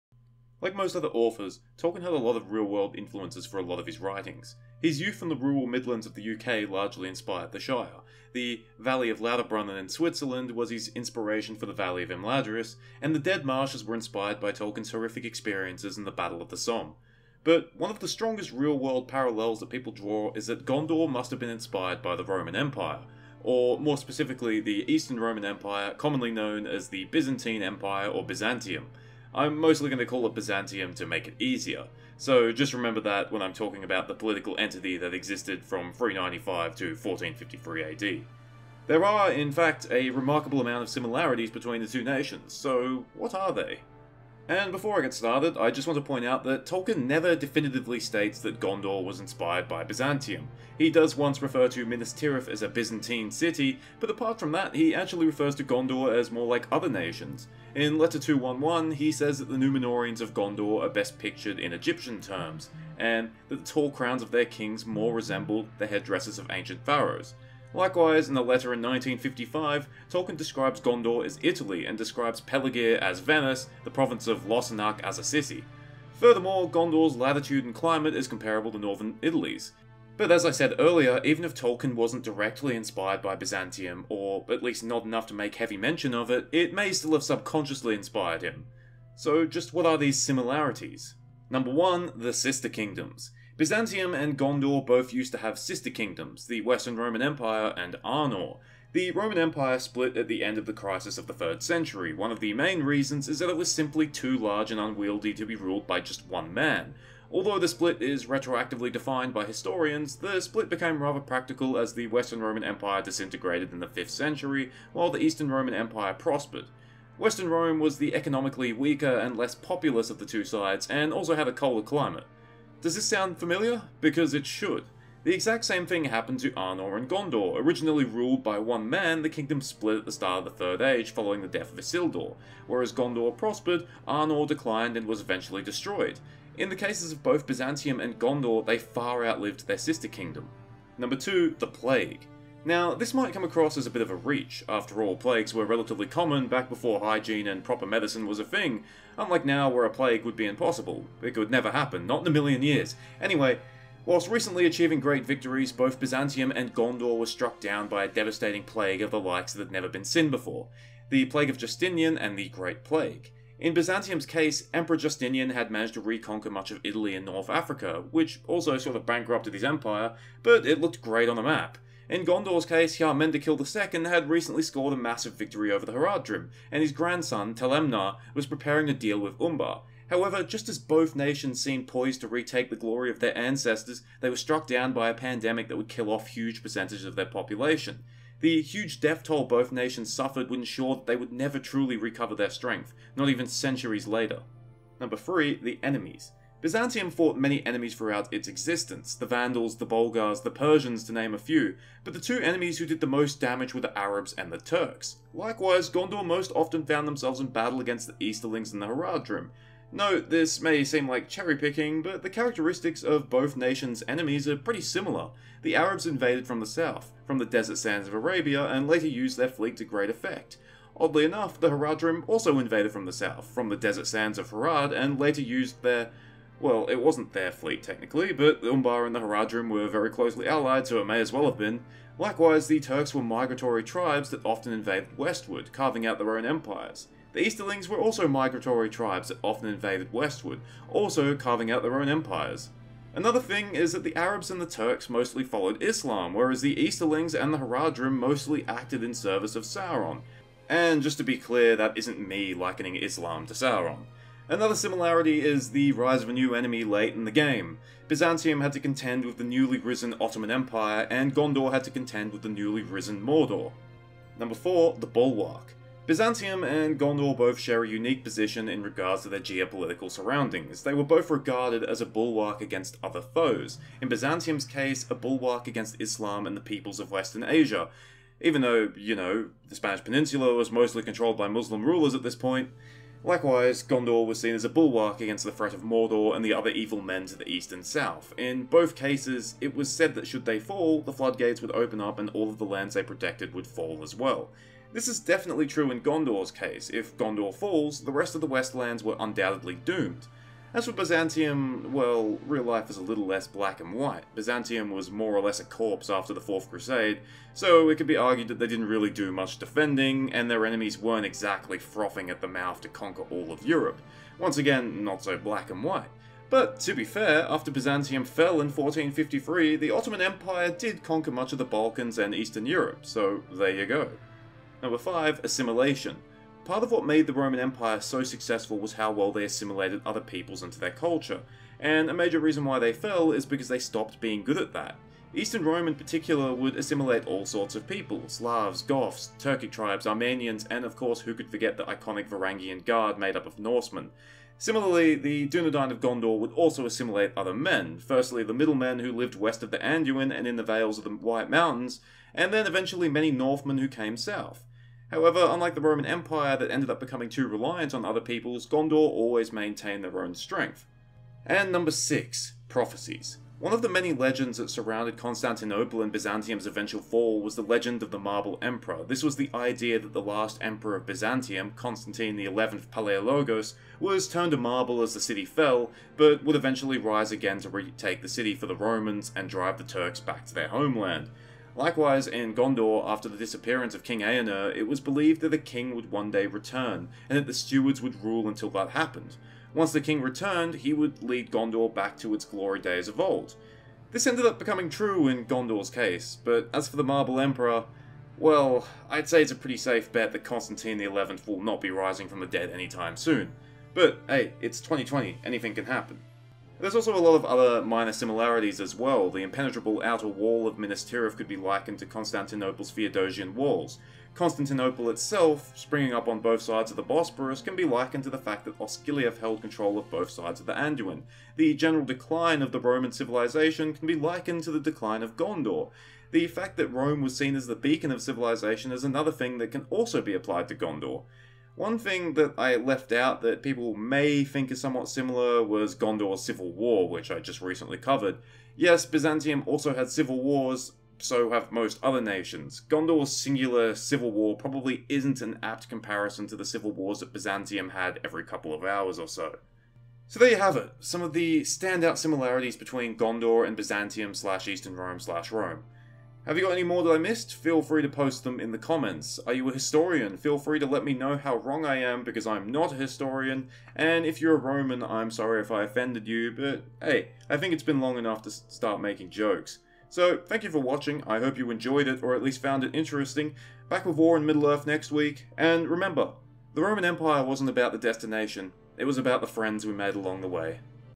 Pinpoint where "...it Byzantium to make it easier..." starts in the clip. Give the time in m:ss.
0:30.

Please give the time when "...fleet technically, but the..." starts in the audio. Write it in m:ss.
3:47.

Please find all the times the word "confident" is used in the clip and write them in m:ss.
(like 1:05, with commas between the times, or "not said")
not said.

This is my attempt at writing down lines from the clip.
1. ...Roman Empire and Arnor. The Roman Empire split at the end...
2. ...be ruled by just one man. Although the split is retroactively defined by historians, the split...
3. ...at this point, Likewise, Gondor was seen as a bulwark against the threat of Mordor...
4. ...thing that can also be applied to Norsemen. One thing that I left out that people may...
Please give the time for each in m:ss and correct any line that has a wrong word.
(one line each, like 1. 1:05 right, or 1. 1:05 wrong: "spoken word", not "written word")
1. 1:36 right
2. 1:45 right
3. 4:42 right
4. 7:09 wrong: "Gondor", not "Norsemen".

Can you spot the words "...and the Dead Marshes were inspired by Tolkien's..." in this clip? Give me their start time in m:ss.
0:13.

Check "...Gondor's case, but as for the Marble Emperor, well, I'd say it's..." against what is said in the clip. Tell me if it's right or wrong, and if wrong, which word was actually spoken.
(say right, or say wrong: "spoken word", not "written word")
right.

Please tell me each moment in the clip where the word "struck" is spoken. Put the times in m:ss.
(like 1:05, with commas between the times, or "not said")
2:37, 3:04.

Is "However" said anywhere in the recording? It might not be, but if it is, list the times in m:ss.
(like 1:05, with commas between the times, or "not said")
3:00, 5:55.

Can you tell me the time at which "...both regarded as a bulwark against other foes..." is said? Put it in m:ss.
4:31.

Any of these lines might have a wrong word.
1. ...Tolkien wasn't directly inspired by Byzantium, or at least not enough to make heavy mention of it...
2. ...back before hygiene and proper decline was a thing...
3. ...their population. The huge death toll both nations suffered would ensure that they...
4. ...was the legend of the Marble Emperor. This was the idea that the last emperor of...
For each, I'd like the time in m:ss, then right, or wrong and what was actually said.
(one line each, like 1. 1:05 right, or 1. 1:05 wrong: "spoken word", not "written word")
1. 1:21 right
2. 2:26 wrong: "medicine", not "decline"
3. 3:07 right
4. 6:07 right.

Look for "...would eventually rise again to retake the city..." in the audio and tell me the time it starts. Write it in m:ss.
6:16.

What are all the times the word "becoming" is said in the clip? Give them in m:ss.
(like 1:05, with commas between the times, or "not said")
5:57, 6:34.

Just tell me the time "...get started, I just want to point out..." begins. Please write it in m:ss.
0:45.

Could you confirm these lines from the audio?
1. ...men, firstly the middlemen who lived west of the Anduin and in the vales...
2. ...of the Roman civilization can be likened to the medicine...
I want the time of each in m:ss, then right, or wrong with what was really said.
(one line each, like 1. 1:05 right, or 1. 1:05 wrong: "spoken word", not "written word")
1. 5:47 right
2. 7:02 wrong: "decline", not "medicine".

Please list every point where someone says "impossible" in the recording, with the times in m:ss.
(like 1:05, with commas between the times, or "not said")
2:30.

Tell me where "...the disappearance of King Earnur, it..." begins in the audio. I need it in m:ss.
6:23.